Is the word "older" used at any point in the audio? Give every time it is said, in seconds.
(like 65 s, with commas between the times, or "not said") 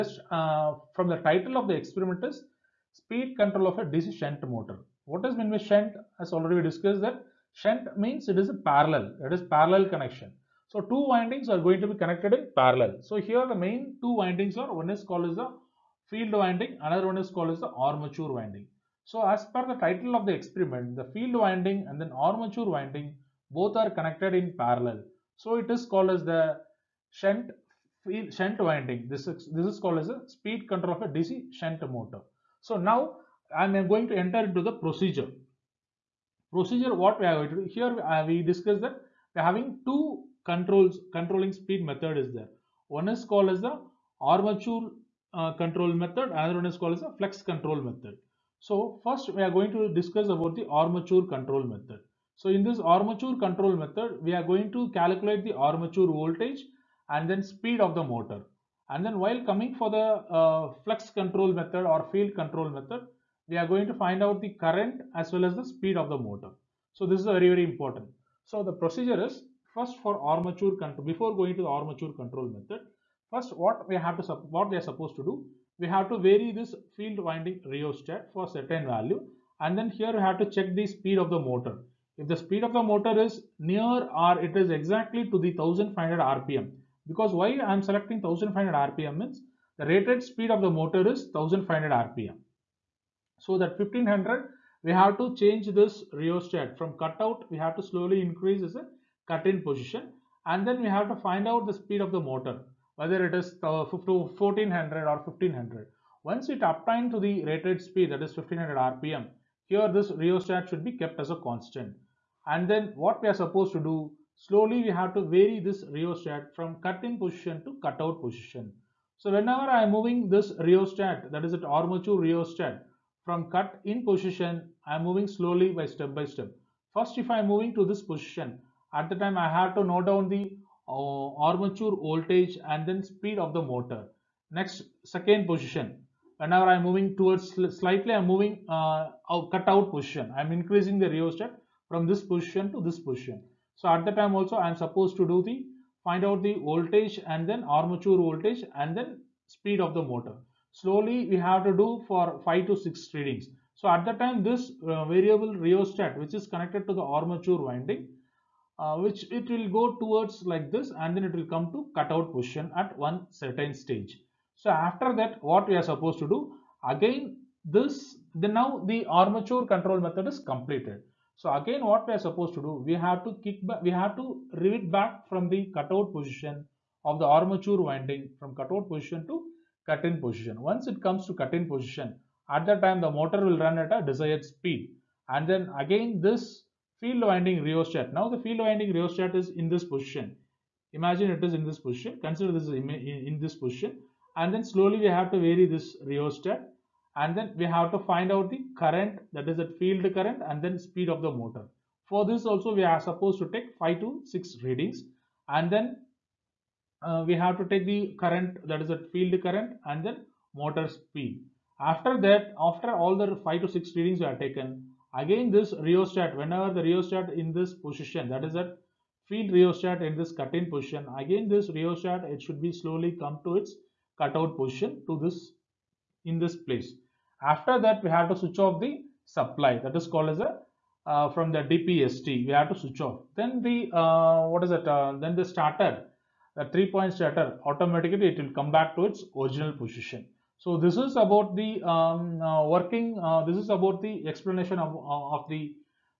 not said.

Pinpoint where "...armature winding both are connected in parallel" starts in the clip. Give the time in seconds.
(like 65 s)
22 s.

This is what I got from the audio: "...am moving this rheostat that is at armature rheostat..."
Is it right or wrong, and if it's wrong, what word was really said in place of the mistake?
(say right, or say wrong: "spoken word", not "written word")
right.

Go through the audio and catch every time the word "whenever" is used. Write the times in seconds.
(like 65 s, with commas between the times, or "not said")
119 s, 136 s, 216 s.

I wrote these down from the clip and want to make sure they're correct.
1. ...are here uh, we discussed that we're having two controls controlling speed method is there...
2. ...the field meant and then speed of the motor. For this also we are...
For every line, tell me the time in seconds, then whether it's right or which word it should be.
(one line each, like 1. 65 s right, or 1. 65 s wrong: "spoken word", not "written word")
1. 37 s right
2. 199 s wrong: "current", not "meant".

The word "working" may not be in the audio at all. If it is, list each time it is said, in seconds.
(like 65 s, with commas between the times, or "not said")
242 s.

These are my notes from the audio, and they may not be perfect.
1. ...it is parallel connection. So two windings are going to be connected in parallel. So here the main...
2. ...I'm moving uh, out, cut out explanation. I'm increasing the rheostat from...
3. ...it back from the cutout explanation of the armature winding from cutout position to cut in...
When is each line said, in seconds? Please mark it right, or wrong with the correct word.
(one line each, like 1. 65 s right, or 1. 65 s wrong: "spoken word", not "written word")
1. 9 s right
2. 138 s wrong: "position", not "explanation"
3. 174 s wrong: "position", not "explanation".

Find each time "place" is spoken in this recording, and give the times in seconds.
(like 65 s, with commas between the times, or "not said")
226 s.